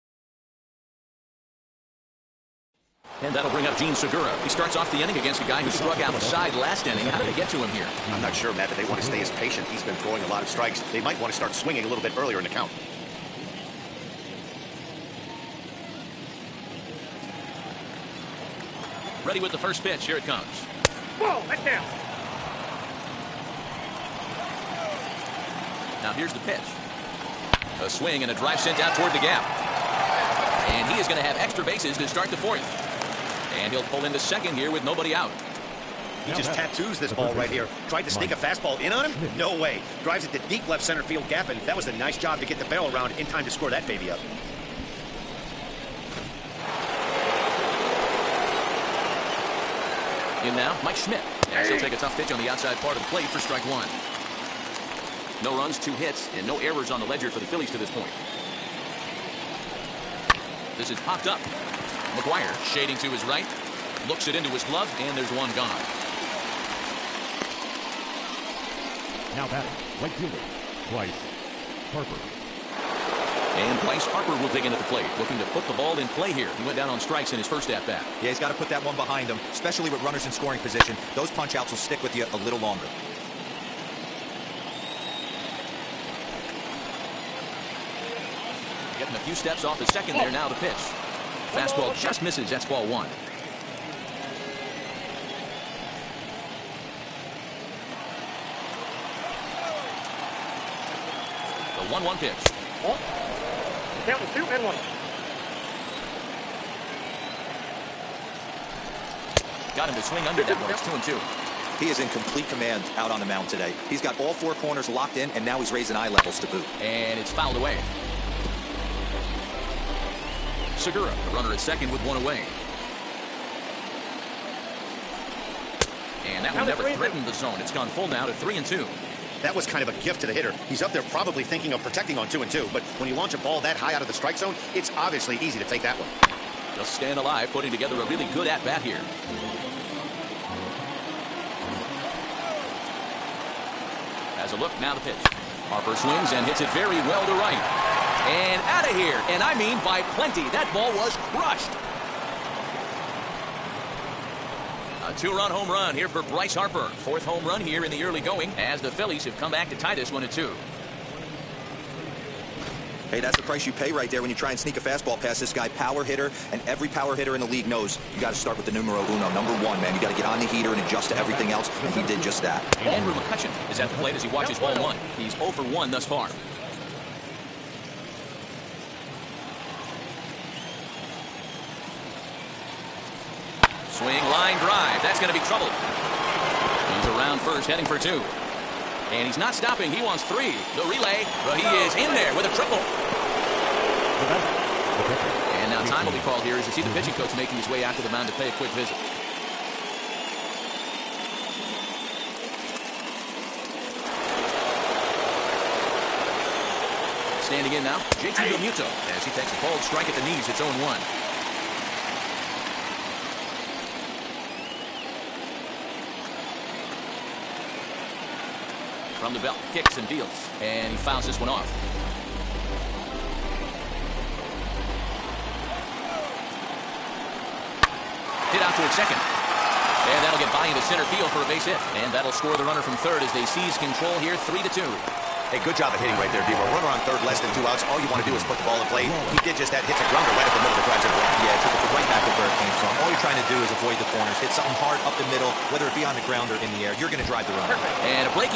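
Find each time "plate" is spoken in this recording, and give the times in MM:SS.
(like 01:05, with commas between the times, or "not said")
00:53, 01:14, 02:54.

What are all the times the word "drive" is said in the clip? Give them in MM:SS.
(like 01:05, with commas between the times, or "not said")
00:28, 00:40, 04:00, 04:07.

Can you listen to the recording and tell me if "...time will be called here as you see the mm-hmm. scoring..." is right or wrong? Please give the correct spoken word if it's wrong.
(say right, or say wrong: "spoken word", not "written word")
wrong: "pitching", not "scoring".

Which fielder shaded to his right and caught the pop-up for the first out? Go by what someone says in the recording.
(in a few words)
McGwire.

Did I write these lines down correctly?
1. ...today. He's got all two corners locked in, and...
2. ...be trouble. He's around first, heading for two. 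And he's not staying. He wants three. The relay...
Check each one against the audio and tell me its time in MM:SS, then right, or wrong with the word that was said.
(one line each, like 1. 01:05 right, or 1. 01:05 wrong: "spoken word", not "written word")
1. 01:53 wrong: "four", not "two"
2. 03:05 wrong: "stopping", not "staying".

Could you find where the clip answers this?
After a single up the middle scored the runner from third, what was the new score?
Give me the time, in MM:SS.
03:54.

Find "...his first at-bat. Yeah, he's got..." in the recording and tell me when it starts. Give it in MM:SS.
01:17.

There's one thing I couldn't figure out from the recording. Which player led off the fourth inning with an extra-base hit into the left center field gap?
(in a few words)
Jean Segura.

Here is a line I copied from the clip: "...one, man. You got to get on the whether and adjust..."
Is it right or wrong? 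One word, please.
wrong.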